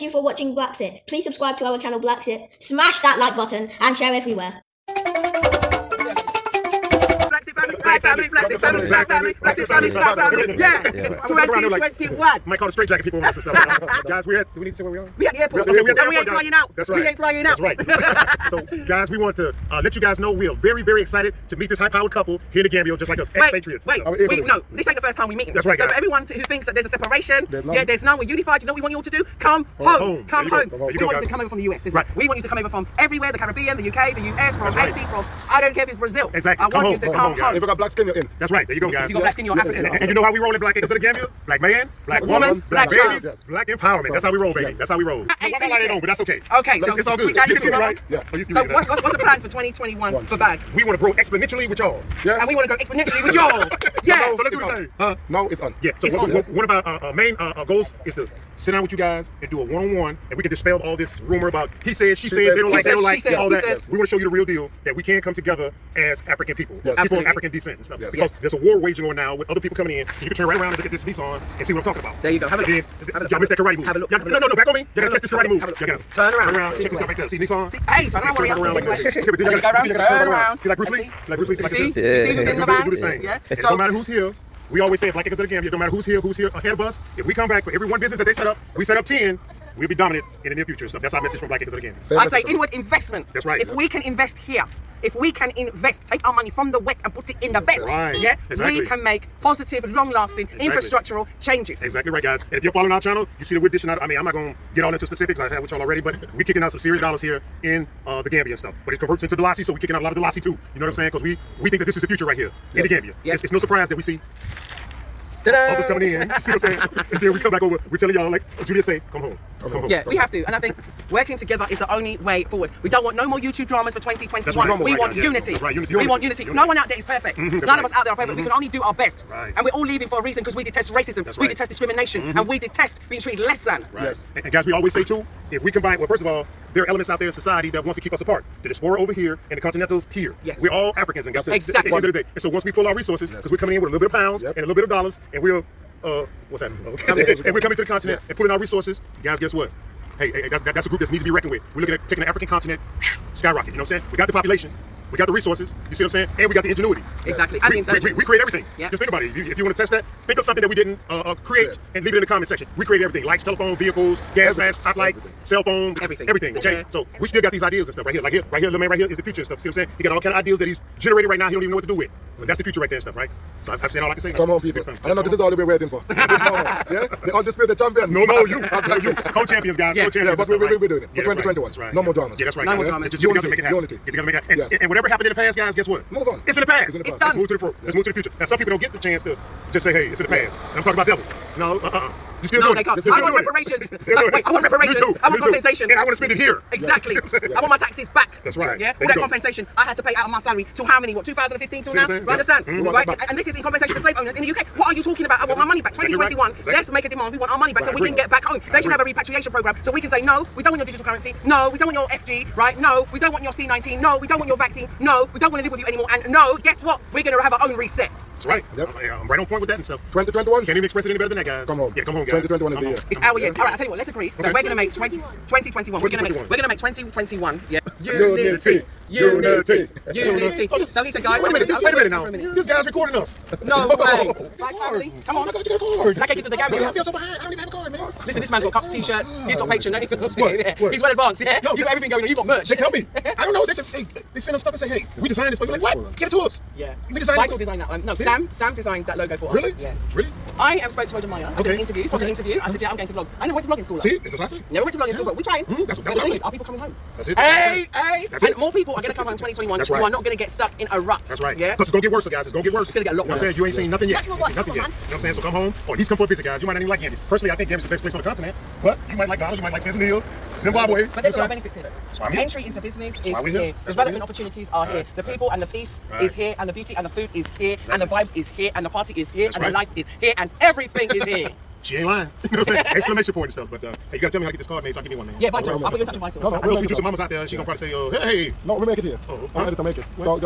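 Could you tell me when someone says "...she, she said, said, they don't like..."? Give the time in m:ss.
1:02.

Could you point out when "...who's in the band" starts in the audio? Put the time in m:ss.
1:22.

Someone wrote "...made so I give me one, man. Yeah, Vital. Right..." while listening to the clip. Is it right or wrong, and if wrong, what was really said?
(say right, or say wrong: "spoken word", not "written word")
right.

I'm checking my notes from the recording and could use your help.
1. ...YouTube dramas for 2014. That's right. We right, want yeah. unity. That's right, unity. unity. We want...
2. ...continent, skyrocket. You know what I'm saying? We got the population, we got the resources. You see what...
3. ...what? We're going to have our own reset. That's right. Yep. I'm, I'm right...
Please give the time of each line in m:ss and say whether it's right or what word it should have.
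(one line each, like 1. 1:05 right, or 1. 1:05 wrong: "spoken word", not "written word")
1. 2:03 wrong: "2021", not "2014"
2. 2:32 right
3. 3:36 right.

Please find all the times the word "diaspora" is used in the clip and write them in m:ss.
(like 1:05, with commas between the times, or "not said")
2:18.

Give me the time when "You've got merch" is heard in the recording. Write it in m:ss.
4:02.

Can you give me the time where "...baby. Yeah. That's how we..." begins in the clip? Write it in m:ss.
0:44.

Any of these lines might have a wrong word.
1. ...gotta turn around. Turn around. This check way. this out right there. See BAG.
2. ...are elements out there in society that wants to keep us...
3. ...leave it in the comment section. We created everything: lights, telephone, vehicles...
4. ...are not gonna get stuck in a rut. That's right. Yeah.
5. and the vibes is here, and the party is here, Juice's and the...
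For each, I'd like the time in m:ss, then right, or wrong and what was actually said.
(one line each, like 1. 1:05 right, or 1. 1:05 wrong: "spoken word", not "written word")
1. 1:15 wrong: "Nissan", not "BAG"
2. 2:16 right
3. 2:42 right
4. 4:20 right
5. 4:37 wrong: "That", not "Juice".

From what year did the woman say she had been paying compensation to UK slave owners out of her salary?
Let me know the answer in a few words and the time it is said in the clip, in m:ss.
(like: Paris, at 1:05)
2015, at 3:21.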